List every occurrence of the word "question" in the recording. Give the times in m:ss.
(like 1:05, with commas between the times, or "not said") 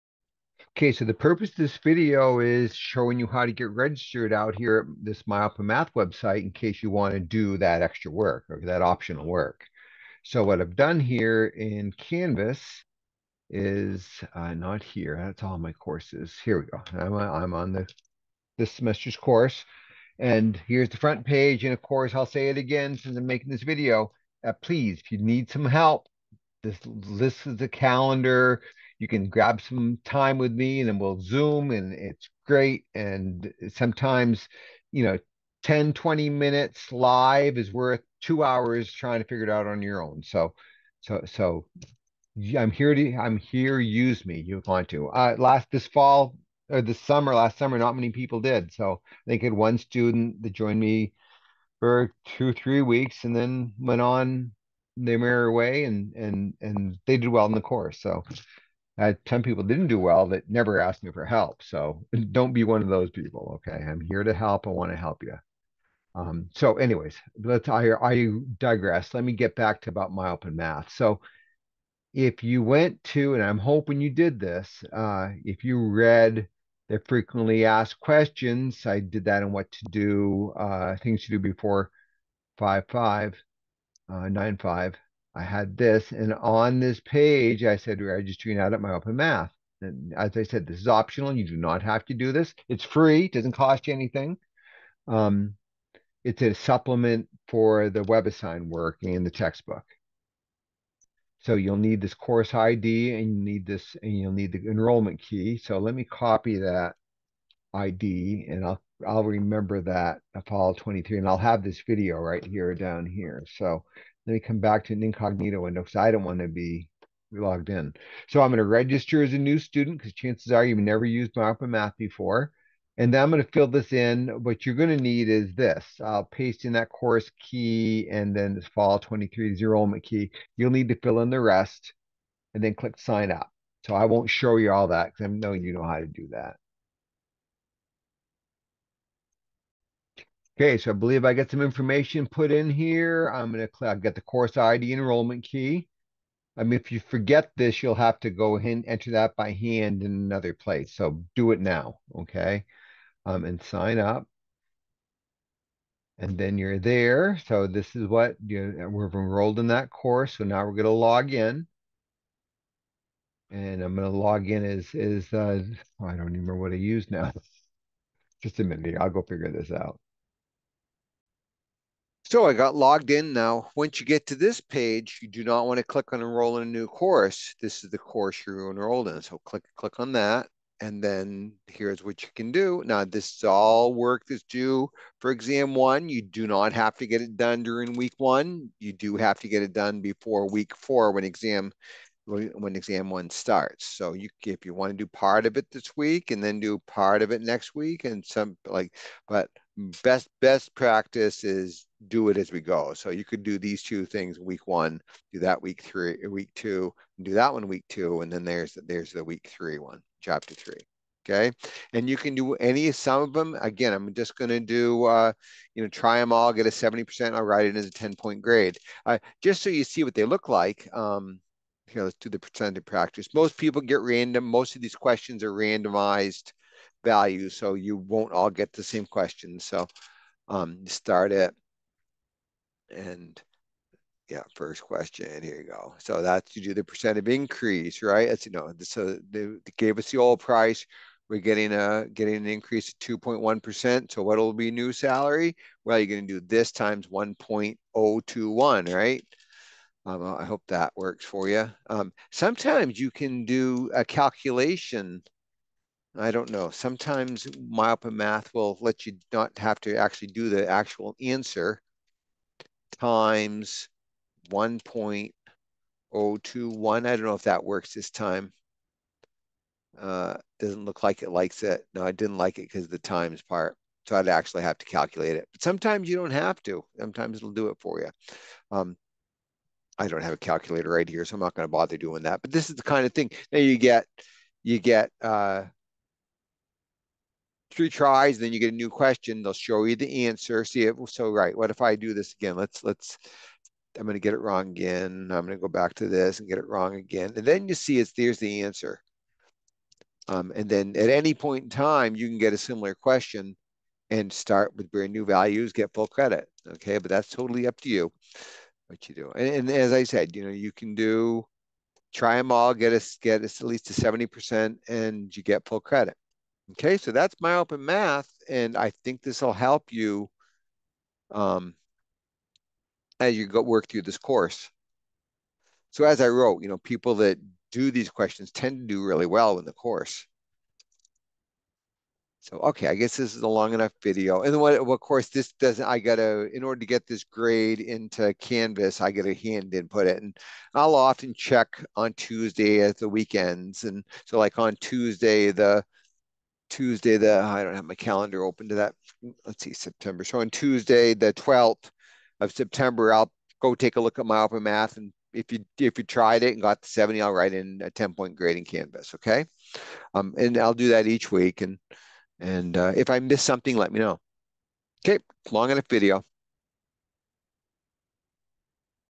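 1:18, 3:44, 3:49, 3:54, 4:48, 5:02, 5:28.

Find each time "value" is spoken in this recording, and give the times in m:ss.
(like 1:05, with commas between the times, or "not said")
3:47, 5:05.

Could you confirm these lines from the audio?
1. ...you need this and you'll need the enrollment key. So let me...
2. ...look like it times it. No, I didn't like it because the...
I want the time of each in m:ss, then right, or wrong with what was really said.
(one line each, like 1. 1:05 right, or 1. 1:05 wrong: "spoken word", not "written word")
1. 1:43 right
2. 4:30 wrong: "likes", not "times".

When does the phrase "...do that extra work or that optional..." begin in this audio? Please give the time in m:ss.
0:07.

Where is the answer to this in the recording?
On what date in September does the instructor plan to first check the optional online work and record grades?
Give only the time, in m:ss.
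5:51.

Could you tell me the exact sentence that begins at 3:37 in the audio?
I'll write it as a ten point grade, uh, just so you see what they look like.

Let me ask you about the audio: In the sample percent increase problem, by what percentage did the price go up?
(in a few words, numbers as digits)
2.1%.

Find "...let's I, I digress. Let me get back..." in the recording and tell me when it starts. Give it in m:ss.
1:07.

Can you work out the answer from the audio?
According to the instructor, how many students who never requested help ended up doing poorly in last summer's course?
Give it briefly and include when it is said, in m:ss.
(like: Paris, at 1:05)
10, at 0:59.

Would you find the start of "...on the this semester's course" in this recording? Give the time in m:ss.
0:17.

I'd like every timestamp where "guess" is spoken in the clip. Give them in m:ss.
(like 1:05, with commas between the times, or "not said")
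5:32.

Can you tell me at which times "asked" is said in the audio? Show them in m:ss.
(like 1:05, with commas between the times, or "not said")
1:00, 1:17.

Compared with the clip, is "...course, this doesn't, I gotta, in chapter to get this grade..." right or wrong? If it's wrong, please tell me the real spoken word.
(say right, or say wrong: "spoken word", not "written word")
wrong: "order", not "chapter".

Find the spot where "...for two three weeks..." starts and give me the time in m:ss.
0:51.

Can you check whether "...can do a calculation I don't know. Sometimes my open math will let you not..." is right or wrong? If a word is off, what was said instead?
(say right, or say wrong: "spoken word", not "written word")
right.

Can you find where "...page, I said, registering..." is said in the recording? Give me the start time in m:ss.
1:27.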